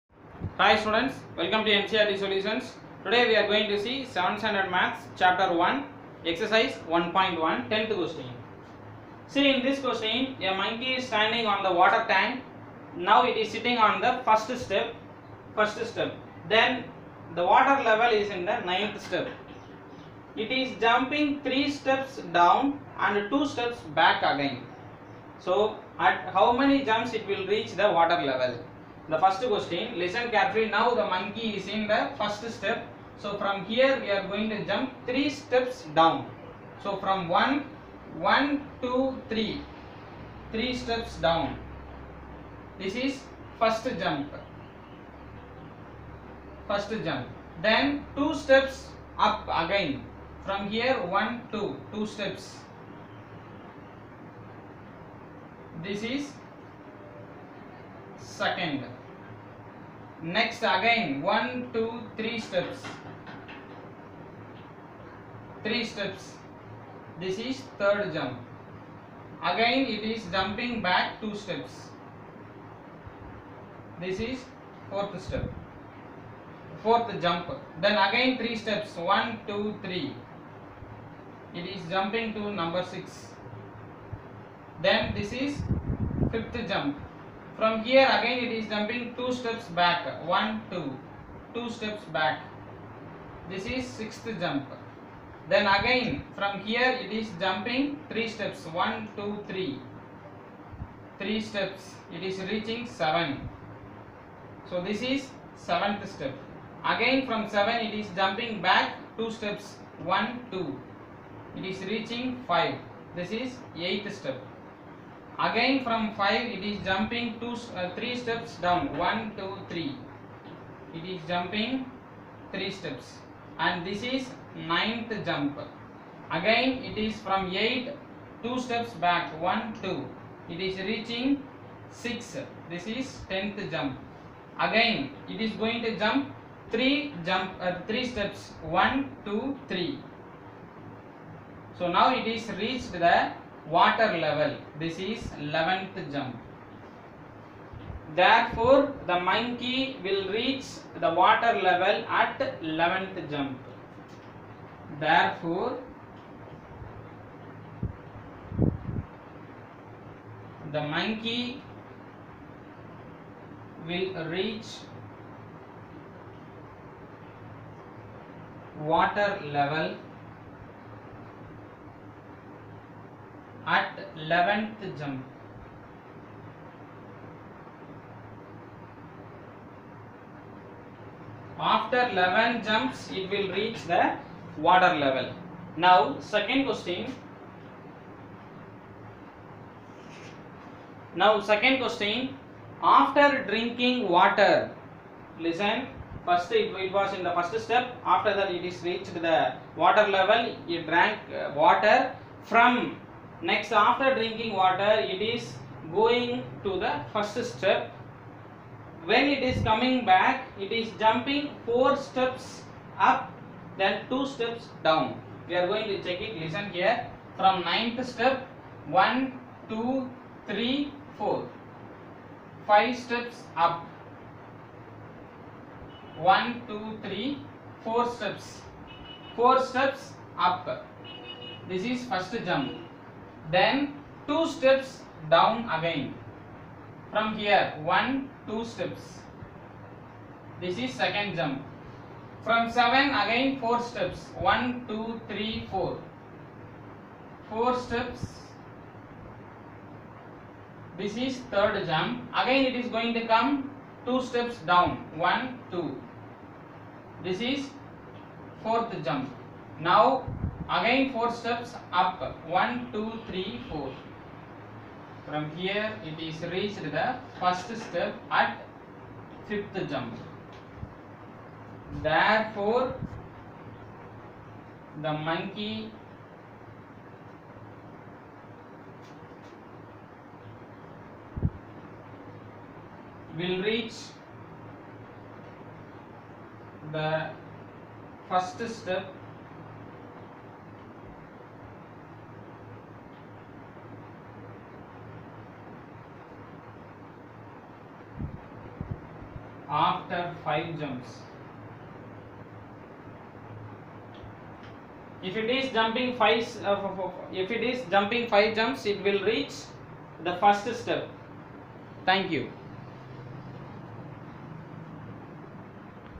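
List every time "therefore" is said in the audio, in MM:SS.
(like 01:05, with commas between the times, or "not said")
02:28, 02:34, 04:32.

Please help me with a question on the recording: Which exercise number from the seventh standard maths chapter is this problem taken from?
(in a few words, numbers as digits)
1.1.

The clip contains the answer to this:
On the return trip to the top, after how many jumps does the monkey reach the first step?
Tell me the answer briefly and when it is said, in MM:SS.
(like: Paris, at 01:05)
5, at 04:59.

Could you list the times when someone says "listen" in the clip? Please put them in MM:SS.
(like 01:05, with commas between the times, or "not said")
00:30, 03:15, 03:36.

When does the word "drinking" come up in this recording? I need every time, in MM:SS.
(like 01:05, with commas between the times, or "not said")
03:13, 03:24.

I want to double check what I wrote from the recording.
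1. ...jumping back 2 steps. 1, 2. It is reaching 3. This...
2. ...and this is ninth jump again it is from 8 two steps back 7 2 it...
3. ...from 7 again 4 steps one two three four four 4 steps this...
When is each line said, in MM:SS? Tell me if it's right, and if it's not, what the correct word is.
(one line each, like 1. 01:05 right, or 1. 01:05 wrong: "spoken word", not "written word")
1. 01:48 wrong: "5", not "3"
2. 02:03 wrong: "1", not "7"
3. 04:02 right.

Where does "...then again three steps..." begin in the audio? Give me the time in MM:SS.
01:17.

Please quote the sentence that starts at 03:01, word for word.
After 11 jumps, it will reach the water level.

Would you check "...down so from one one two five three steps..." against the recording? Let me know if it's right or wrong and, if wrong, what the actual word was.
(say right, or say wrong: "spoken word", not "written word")
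wrong: "three", not "five".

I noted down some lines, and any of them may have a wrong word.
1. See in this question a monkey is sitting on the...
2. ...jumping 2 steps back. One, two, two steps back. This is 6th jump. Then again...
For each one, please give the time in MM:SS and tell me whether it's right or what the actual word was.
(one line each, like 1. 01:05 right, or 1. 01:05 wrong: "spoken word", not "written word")
1. 00:09 wrong: "standing", not "sitting"
2. 01:28 right.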